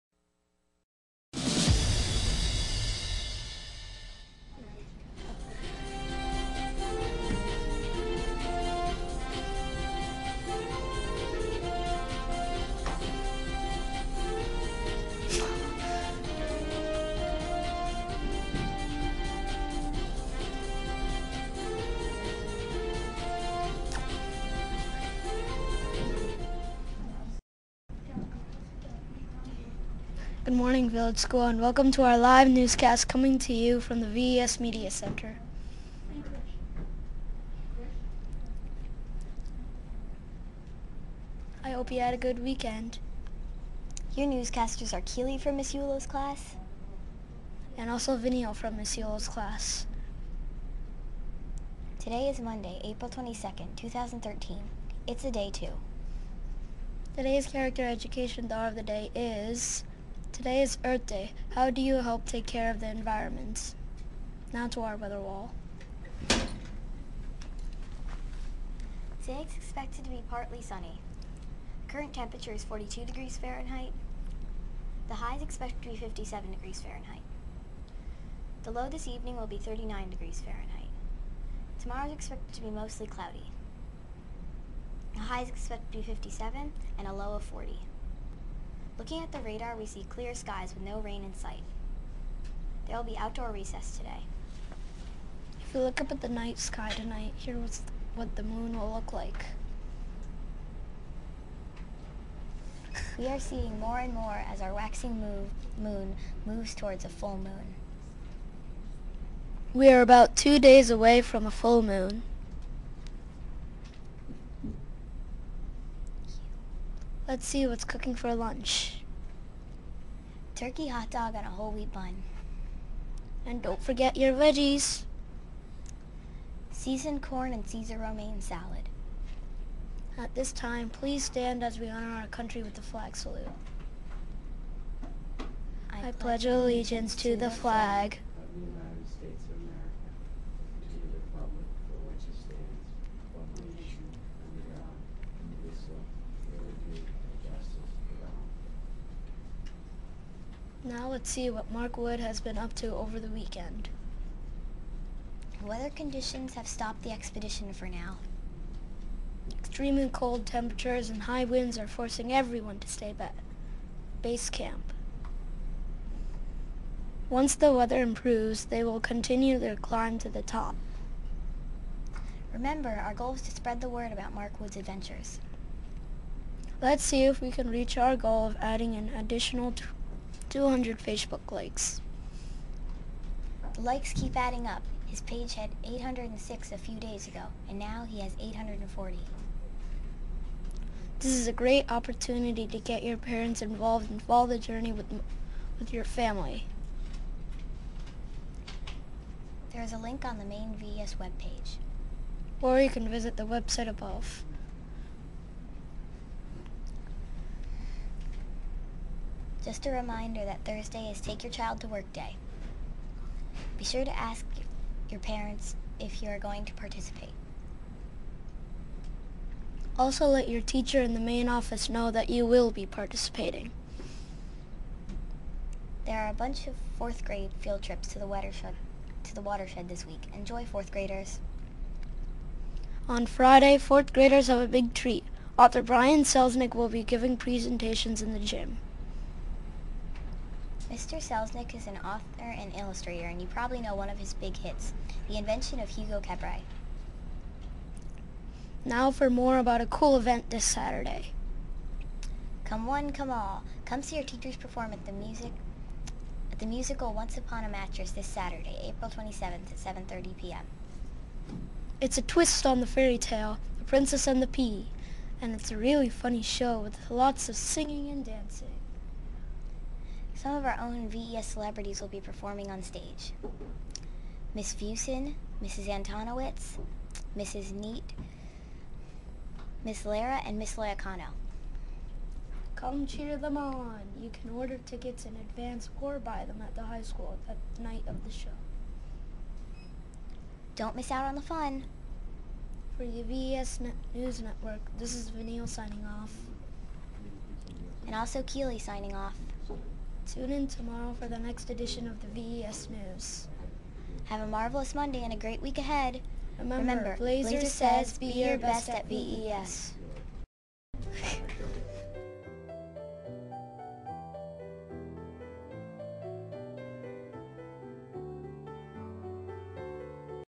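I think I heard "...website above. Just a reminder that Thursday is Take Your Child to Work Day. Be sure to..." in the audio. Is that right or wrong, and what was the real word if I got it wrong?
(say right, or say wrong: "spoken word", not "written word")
right.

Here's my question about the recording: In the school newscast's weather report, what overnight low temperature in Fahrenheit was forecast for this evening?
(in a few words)
39 degrees.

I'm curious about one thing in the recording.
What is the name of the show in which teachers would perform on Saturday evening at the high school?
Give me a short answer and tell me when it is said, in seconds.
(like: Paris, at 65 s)
Once Upon a Mattress, at 257 s.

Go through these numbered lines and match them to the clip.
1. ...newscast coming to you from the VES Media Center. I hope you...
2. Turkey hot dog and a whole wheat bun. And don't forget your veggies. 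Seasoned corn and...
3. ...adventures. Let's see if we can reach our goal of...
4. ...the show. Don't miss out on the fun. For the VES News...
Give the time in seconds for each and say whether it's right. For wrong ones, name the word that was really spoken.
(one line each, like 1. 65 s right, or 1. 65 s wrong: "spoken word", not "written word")
1. 32 s right
2. 120 s right
3. 174 s right
4. 288 s right.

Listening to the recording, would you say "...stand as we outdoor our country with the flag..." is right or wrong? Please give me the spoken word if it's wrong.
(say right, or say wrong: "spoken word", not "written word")
wrong: "honor", not "outdoor".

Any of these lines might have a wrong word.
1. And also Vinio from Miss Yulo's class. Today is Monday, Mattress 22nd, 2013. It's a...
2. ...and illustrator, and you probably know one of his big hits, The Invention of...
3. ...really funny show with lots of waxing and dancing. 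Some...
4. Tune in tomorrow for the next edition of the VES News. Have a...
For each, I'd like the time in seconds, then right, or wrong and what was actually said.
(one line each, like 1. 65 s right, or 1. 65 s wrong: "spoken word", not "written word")
1. 47 s wrong: "April", not "Mattress"
2. 242 s right
3. 265 s wrong: "singing", not "waxing"
4. 300 s right.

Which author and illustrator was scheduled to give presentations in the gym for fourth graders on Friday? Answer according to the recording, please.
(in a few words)
Brian Selznick.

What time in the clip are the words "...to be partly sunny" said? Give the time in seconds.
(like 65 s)
70 s.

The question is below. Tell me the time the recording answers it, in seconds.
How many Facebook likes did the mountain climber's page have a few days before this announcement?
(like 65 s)
185 s.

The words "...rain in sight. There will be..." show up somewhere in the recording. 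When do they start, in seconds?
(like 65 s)
90 s.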